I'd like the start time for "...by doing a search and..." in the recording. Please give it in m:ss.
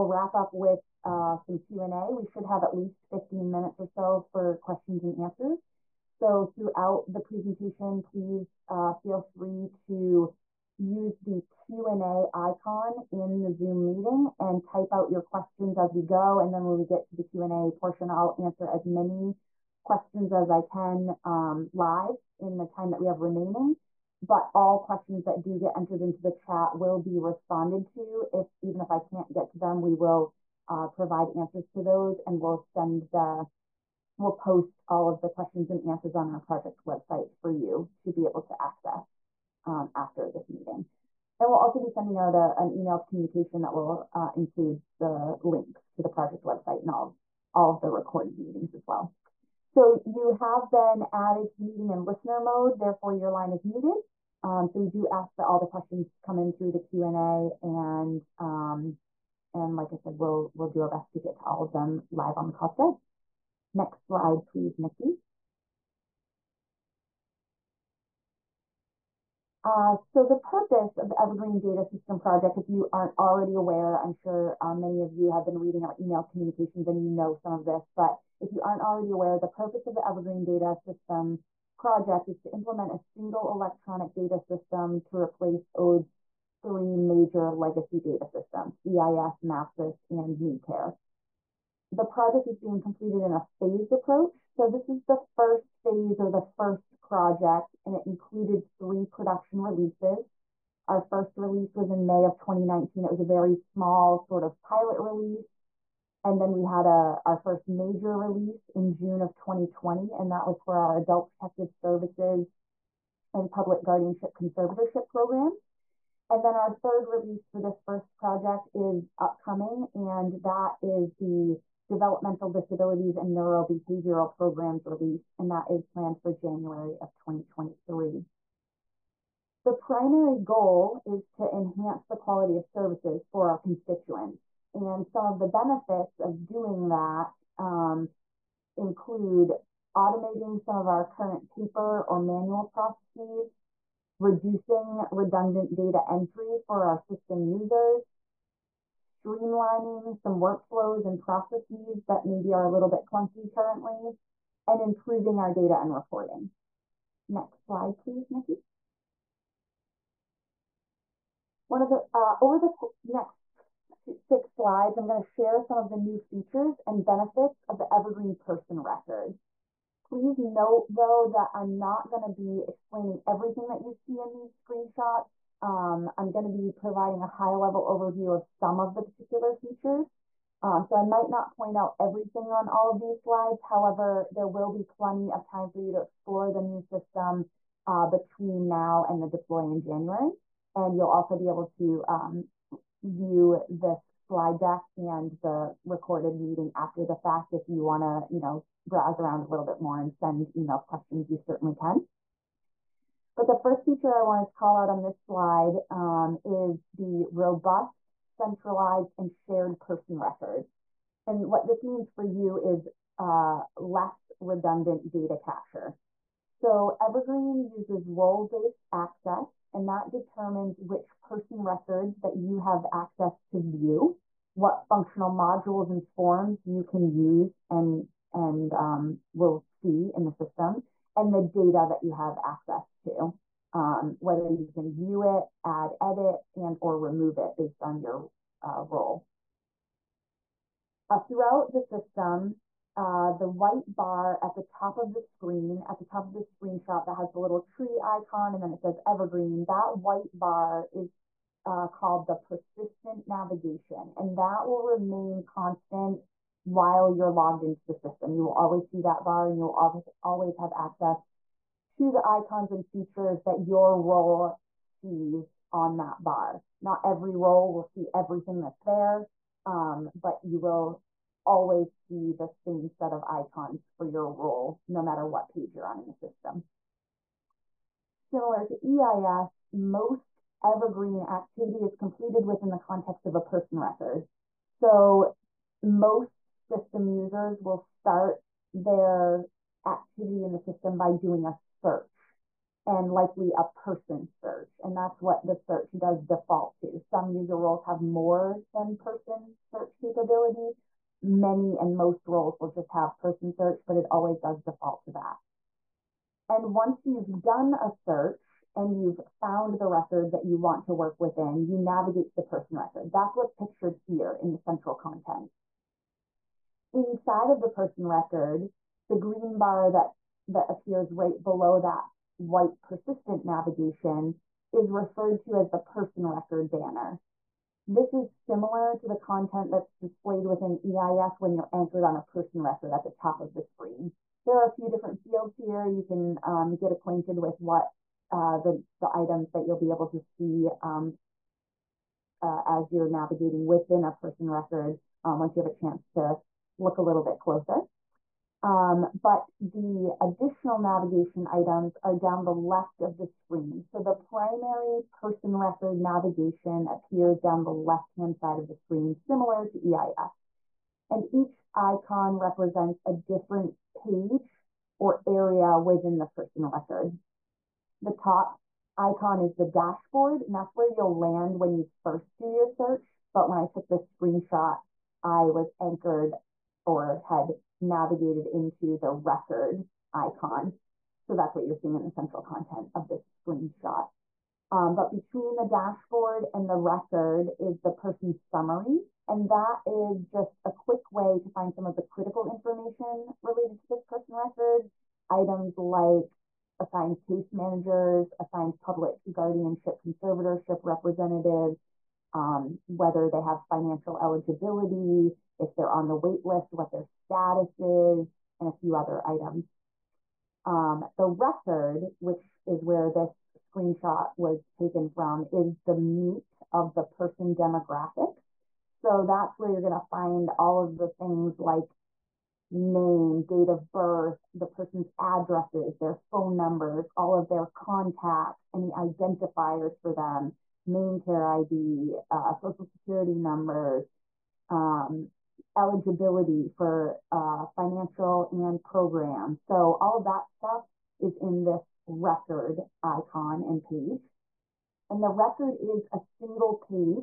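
4:50.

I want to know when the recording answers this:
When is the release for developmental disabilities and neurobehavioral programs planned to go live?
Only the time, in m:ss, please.
2:06.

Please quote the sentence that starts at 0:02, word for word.
We should have at least 15 minutes or so for questions and answers.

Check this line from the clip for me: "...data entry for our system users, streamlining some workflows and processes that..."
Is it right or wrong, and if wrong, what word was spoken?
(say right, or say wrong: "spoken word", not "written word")
right.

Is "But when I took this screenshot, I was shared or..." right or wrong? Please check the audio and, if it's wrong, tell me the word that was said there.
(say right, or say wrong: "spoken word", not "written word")
wrong: "anchored", not "shared".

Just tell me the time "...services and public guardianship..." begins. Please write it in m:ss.
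1:51.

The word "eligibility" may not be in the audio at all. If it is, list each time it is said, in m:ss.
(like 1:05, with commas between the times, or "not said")
6:44, 7:15.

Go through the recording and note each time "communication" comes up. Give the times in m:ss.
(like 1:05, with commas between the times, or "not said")
0:43, 1:16.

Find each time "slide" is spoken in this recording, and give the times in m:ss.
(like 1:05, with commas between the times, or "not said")
1:04, 2:37, 2:44, 3:03, 3:14, 3:25.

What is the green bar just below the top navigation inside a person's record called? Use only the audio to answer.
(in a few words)
person record banner.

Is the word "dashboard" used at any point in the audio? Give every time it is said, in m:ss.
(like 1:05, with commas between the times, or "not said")
6:09, 6:25.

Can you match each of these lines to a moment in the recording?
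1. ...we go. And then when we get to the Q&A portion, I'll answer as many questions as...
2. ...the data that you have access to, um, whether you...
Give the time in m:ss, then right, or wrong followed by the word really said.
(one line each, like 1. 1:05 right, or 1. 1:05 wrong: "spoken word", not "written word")
1. 0:15 right
2. 3:51 right.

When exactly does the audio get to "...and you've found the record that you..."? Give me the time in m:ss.
5:08.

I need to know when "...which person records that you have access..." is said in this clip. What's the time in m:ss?
3:40.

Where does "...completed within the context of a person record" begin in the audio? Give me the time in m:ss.
4:41.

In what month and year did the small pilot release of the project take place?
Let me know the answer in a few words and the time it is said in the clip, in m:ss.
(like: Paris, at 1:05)
May 2019, at 1:42.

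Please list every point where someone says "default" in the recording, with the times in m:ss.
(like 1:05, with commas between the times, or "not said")
4:56, 5:04.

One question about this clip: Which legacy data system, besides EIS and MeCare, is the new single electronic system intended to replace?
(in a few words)
MAPSIS.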